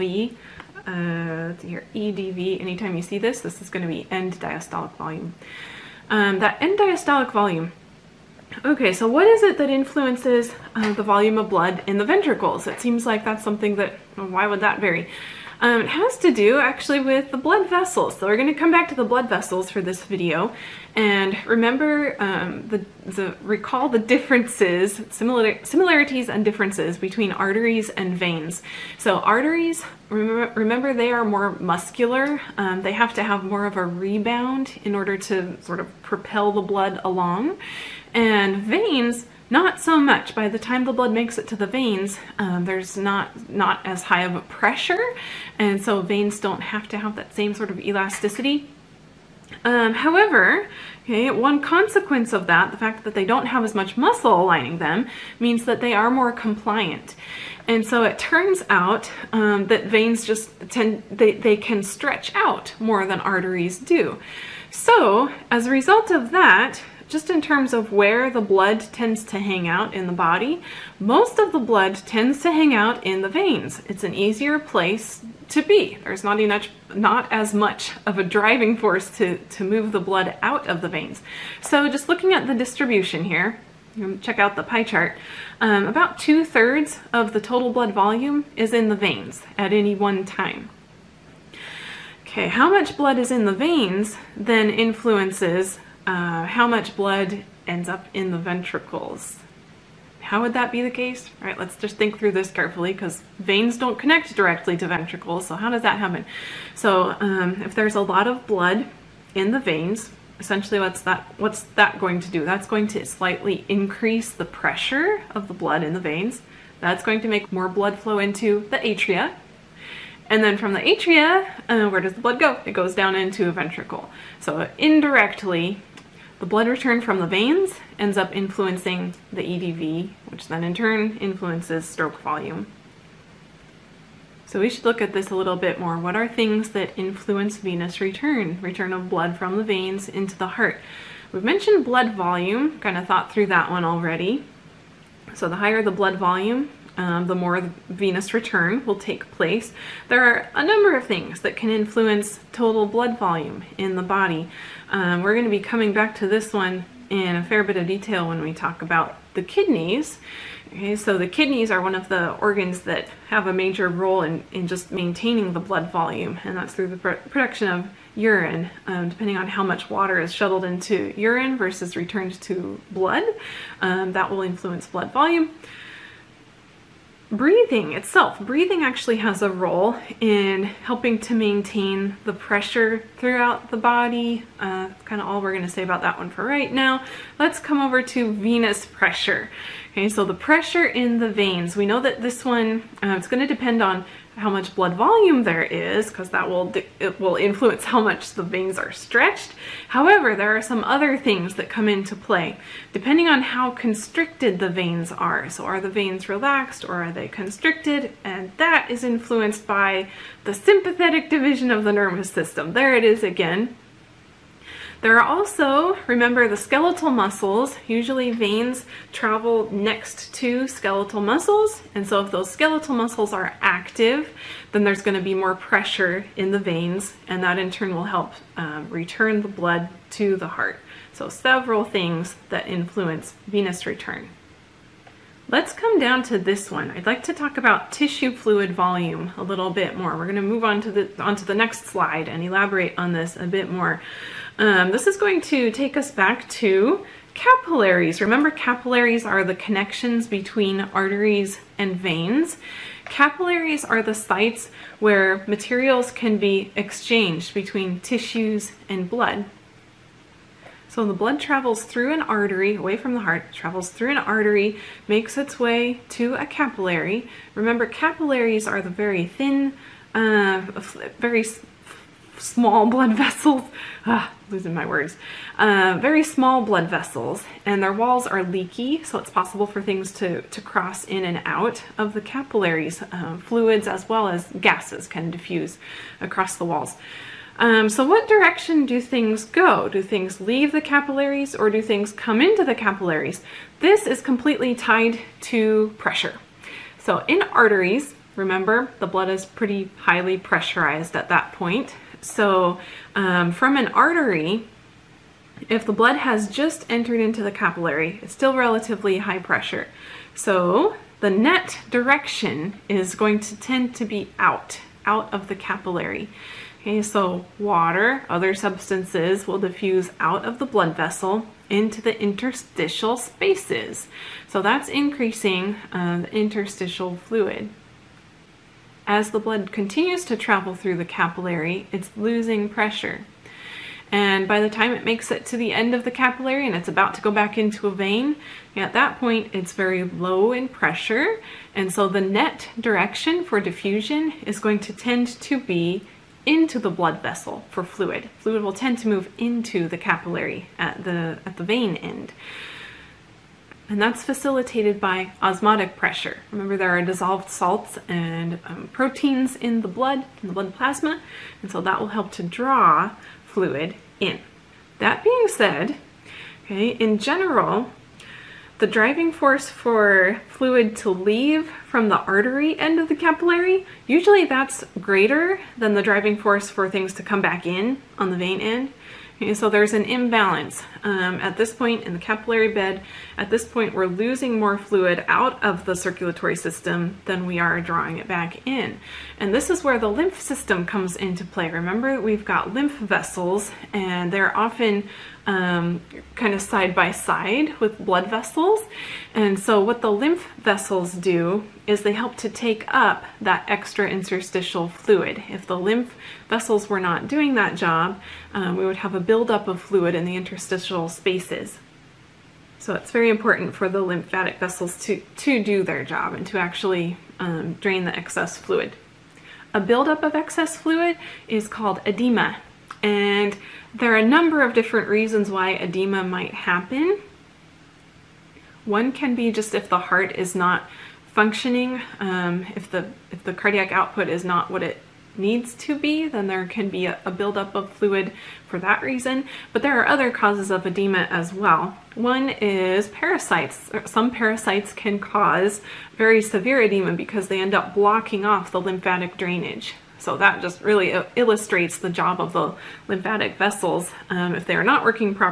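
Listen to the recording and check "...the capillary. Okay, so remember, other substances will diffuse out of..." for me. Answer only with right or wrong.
wrong.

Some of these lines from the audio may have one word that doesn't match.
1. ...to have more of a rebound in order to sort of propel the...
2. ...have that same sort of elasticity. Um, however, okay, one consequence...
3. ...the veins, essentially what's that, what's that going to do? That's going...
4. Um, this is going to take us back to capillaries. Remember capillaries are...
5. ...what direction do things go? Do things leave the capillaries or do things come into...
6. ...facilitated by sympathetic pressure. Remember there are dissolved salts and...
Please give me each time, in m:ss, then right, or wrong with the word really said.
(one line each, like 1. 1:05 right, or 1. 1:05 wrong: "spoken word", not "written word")
1. 0:33 right
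2. 0:46 right
3. 1:49 right
4. 4:04 right
5. 4:48 right
6. 5:54 wrong: "osmotic", not "sympathetic".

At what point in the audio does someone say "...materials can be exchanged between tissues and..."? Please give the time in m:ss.
4:15.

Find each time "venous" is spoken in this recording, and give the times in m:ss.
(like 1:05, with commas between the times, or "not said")
2:17, 2:27, 3:08, 3:53.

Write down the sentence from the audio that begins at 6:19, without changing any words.
Okay, so there's an imbalance um, at this point in the capillary bed.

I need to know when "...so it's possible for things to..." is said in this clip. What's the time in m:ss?
4:39.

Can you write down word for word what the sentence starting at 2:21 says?
We've mentioned blood volume, kind of thought through that one already.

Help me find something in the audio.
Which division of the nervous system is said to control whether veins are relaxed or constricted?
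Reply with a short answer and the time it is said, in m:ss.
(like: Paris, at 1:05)
sympathetic division, at 3:30.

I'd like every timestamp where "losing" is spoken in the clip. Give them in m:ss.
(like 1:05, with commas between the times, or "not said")
4:34, 5:32, 6:24.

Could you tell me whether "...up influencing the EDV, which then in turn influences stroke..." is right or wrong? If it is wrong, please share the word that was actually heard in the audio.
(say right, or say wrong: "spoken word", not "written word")
right.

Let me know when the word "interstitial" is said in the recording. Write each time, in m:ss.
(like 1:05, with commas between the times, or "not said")
5:22, 5:26, 6:44, 6:50.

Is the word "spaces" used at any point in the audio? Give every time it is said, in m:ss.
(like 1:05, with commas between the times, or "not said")
5:23, 6:51.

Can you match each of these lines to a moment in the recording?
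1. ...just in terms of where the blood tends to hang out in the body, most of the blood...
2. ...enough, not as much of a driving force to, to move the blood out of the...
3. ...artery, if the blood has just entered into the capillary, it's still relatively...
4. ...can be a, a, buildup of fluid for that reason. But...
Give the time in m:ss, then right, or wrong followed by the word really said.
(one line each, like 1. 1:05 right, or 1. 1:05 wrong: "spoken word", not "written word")
1. 1:07 right
2. 1:16 right
3. 5:03 right
4. 7:16 right.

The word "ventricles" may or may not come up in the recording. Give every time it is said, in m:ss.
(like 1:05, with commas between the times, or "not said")
0:12, 1:38, 1:44, 2:03.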